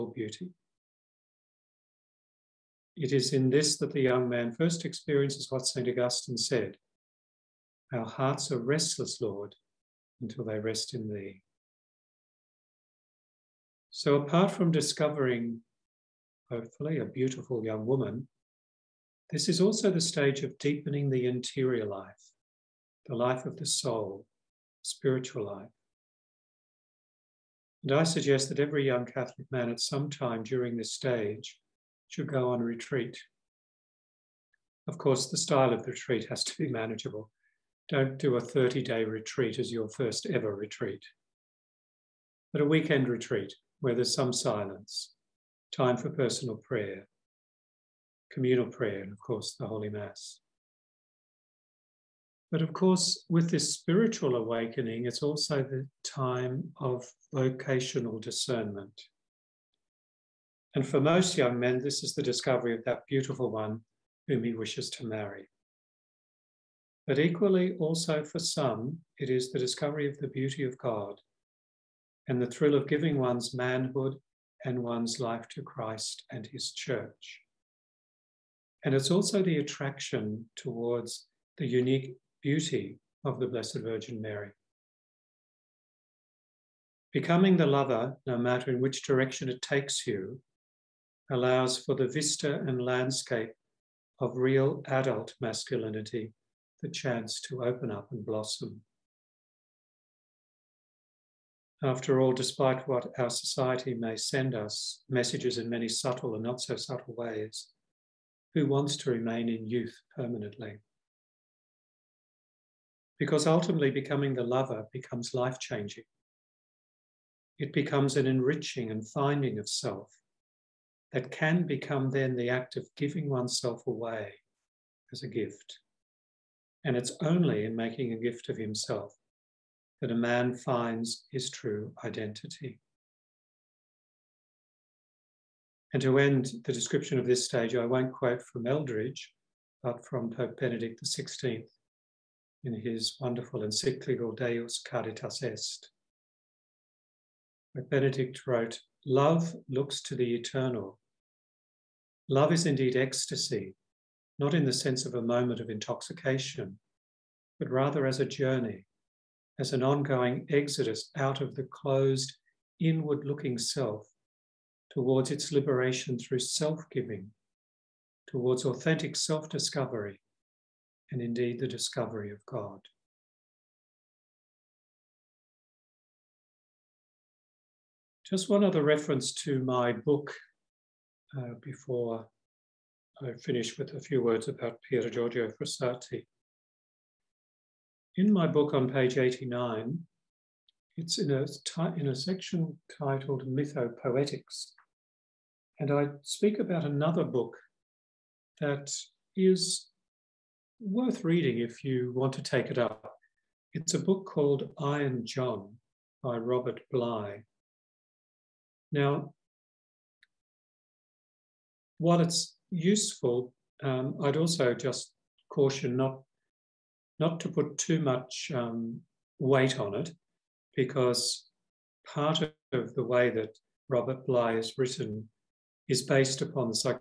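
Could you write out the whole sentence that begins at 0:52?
But of course, with this spiritual awakening, it's also the time of vocational discernment.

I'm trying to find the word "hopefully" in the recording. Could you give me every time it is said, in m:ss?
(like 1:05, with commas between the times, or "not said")
0:16.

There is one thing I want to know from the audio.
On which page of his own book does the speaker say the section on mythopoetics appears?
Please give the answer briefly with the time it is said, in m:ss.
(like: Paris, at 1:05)
89, at 3:09.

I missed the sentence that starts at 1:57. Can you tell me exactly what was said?
It becomes an enriching and finding of self that can become then the act of giving oneself away as a gift.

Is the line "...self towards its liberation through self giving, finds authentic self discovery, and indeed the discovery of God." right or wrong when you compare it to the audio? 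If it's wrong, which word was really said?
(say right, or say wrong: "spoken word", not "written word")
wrong: "towards", not "finds".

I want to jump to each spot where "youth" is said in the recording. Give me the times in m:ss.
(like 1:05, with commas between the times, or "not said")
1:49.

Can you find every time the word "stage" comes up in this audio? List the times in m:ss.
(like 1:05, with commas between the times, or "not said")
0:20, 0:30, 2:17.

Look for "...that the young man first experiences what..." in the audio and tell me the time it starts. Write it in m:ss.
0:03.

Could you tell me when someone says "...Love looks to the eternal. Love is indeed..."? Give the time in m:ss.
2:29.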